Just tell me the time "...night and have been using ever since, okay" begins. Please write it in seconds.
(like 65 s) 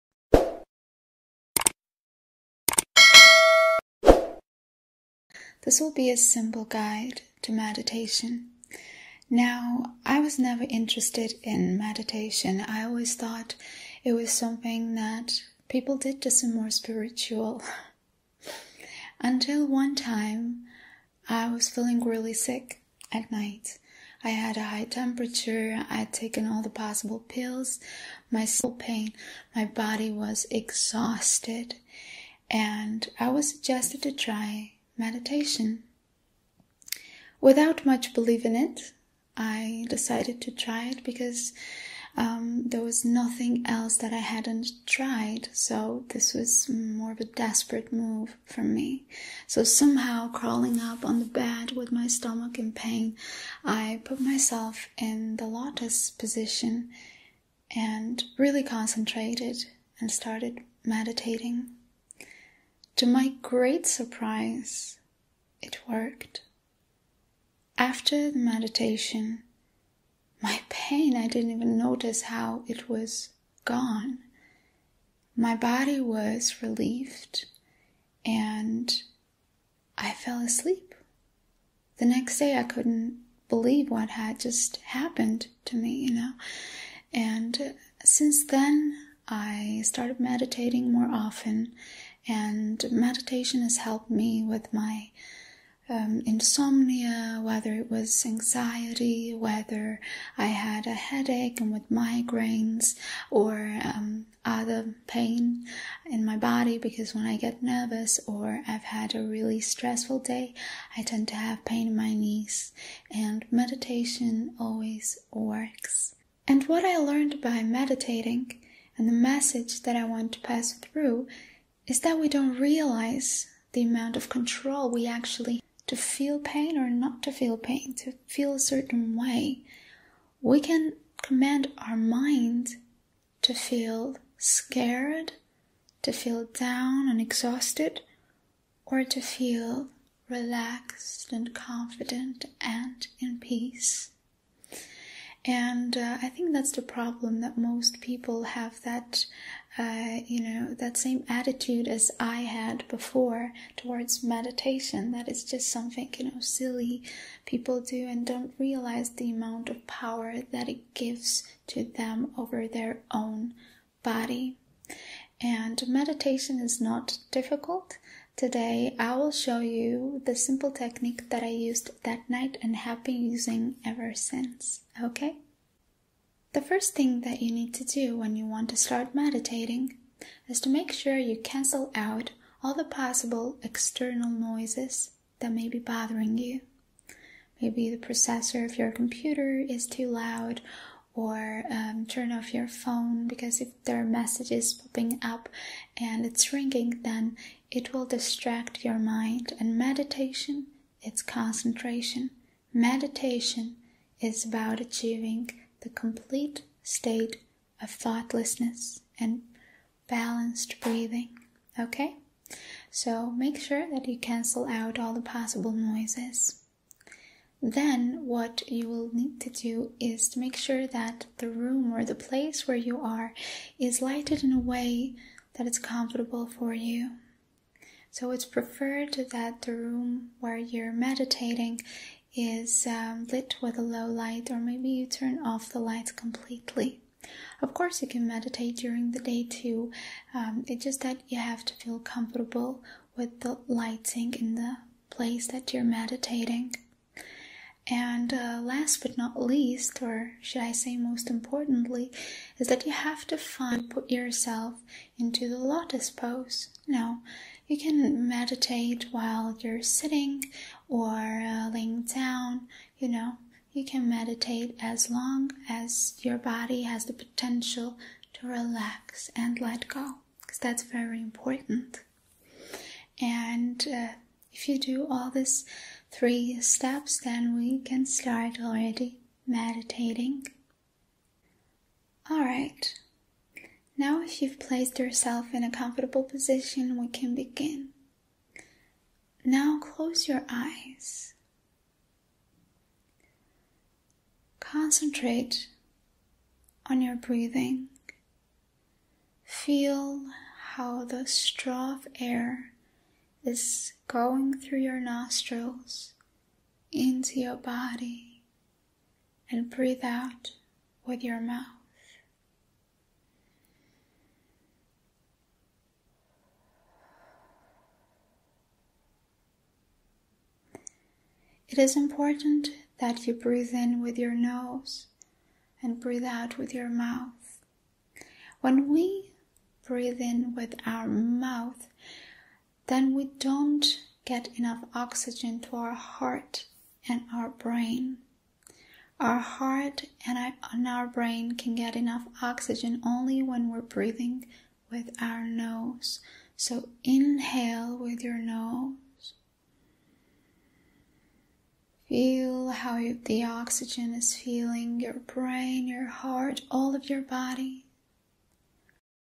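172 s.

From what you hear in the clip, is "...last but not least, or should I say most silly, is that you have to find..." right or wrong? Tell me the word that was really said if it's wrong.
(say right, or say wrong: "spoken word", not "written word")
wrong: "importantly", not "silly".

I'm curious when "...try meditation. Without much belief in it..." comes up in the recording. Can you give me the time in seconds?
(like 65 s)
34 s.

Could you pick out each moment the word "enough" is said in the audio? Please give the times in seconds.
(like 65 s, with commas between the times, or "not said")
334 s, 341 s.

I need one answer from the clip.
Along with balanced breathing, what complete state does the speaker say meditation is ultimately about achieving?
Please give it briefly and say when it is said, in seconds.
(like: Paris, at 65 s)
thoughtlessness, at 207 s.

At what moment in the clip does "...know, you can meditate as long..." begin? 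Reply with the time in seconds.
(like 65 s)
263 s.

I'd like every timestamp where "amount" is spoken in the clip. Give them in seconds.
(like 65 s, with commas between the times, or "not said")
123 s, 159 s.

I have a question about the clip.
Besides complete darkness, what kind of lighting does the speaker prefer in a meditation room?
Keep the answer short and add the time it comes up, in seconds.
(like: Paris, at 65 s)
low light, at 233 s.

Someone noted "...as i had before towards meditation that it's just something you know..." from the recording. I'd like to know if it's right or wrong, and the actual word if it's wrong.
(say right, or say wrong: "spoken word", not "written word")
right.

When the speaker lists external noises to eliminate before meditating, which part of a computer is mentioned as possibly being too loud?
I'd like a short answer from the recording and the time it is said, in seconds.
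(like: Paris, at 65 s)
processor, at 188 s.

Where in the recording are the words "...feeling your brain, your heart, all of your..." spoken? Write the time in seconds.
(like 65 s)
354 s.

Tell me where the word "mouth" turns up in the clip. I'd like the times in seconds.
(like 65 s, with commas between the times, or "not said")
311 s, 326 s, 331 s.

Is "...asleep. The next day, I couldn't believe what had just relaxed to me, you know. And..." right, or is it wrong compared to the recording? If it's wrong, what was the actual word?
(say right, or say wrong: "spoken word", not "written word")
wrong: "happened", not "relaxed".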